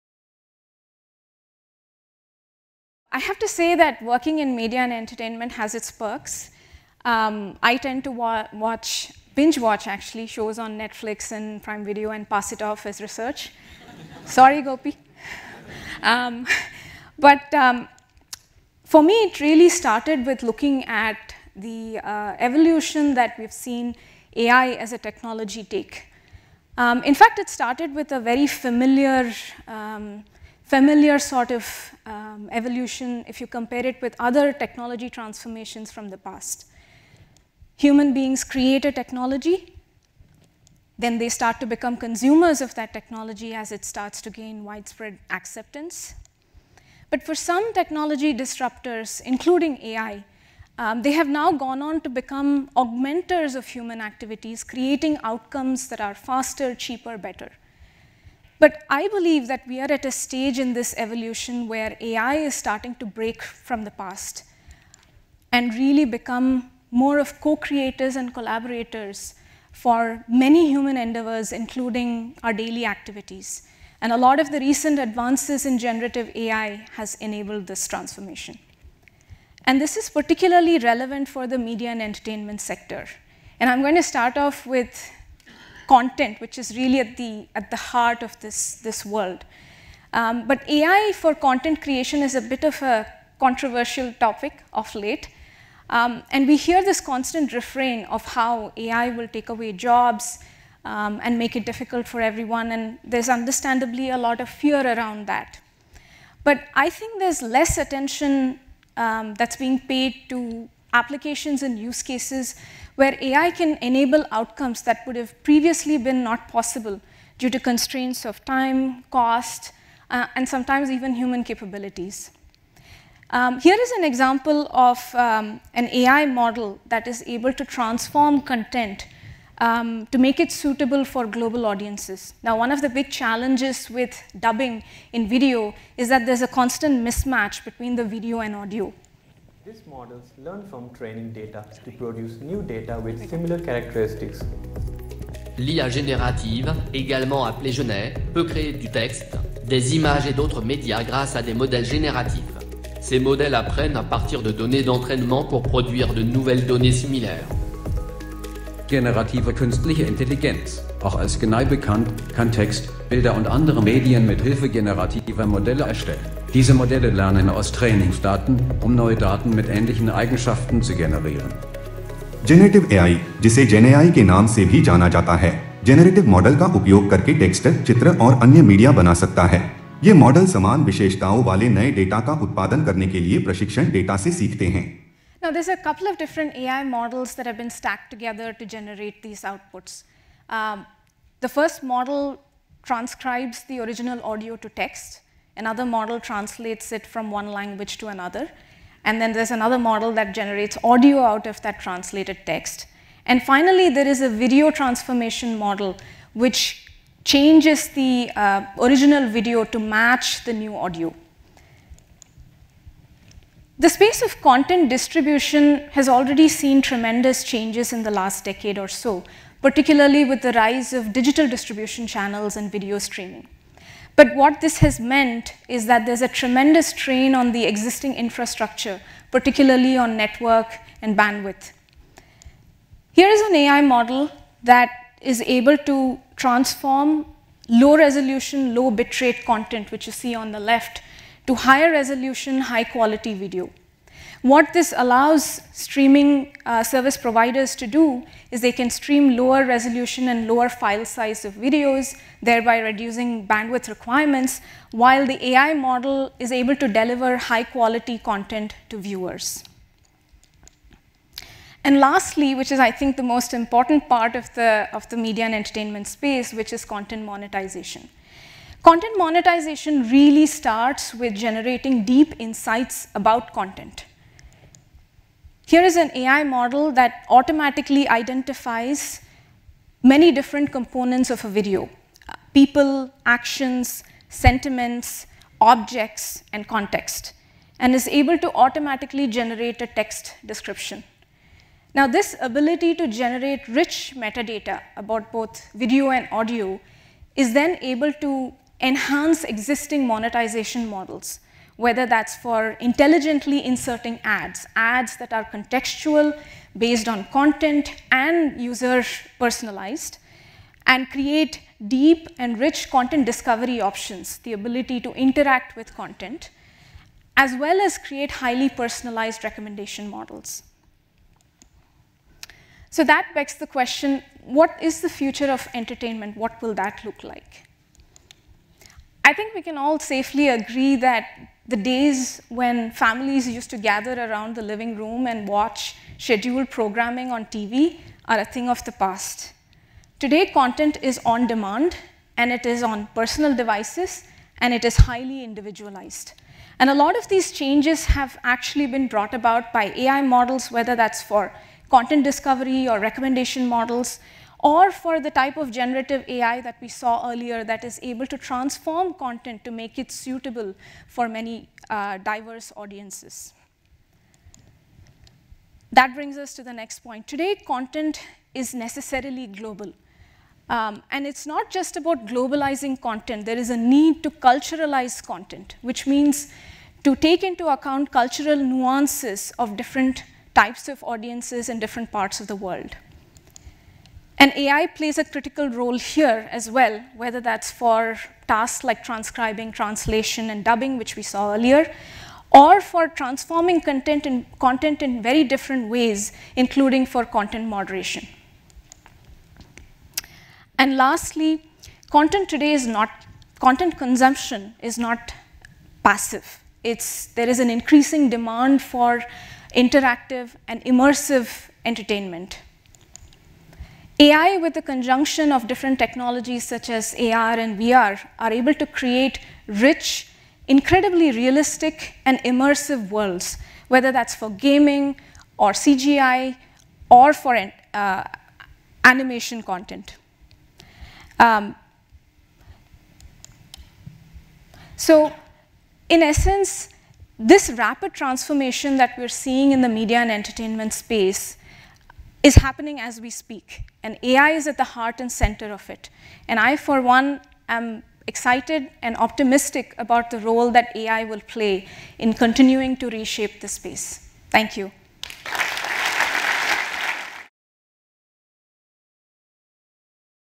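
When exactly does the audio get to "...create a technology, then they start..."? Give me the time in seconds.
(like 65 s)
38 s.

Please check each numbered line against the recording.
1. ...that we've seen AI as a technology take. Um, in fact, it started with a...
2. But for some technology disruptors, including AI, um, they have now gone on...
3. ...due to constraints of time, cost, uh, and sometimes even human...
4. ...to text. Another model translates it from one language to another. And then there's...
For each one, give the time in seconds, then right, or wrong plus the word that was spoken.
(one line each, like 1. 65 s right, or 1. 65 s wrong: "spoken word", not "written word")
1. 23 s right
2. 47 s right
3. 117 s right
4. 194 s right.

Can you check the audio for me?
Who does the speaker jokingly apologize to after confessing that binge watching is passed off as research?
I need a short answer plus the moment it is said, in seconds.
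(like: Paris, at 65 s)
Gopi, at 14 s.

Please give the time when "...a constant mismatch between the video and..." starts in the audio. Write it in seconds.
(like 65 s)
136 s.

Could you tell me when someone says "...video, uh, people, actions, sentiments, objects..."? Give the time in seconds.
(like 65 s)
281 s.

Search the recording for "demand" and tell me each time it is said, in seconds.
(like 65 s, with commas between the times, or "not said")
341 s, 408 s.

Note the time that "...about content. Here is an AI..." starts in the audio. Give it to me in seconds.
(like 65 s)
273 s.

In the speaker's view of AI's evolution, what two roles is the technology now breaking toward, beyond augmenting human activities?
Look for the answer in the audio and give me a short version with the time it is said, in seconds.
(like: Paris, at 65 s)
co-creators and collaborators, at 67 s.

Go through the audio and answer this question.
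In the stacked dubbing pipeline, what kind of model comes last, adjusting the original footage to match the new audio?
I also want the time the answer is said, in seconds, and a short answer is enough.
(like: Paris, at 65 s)
video transformation model, at 204 s.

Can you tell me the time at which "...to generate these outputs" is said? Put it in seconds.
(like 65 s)
188 s.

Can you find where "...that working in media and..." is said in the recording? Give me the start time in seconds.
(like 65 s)
3 s.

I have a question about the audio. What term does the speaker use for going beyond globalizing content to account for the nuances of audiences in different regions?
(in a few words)
culturalize.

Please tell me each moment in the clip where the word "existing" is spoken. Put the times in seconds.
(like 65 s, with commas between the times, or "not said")
227 s, 299 s.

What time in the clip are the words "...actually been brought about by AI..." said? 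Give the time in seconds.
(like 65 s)
348 s.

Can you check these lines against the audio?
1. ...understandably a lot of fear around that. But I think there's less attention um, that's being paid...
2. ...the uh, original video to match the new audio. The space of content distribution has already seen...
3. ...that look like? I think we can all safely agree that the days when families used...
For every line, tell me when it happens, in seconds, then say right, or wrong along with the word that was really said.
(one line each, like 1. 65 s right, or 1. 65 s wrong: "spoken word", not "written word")
1. 103 s right
2. 207 s right
3. 326 s right.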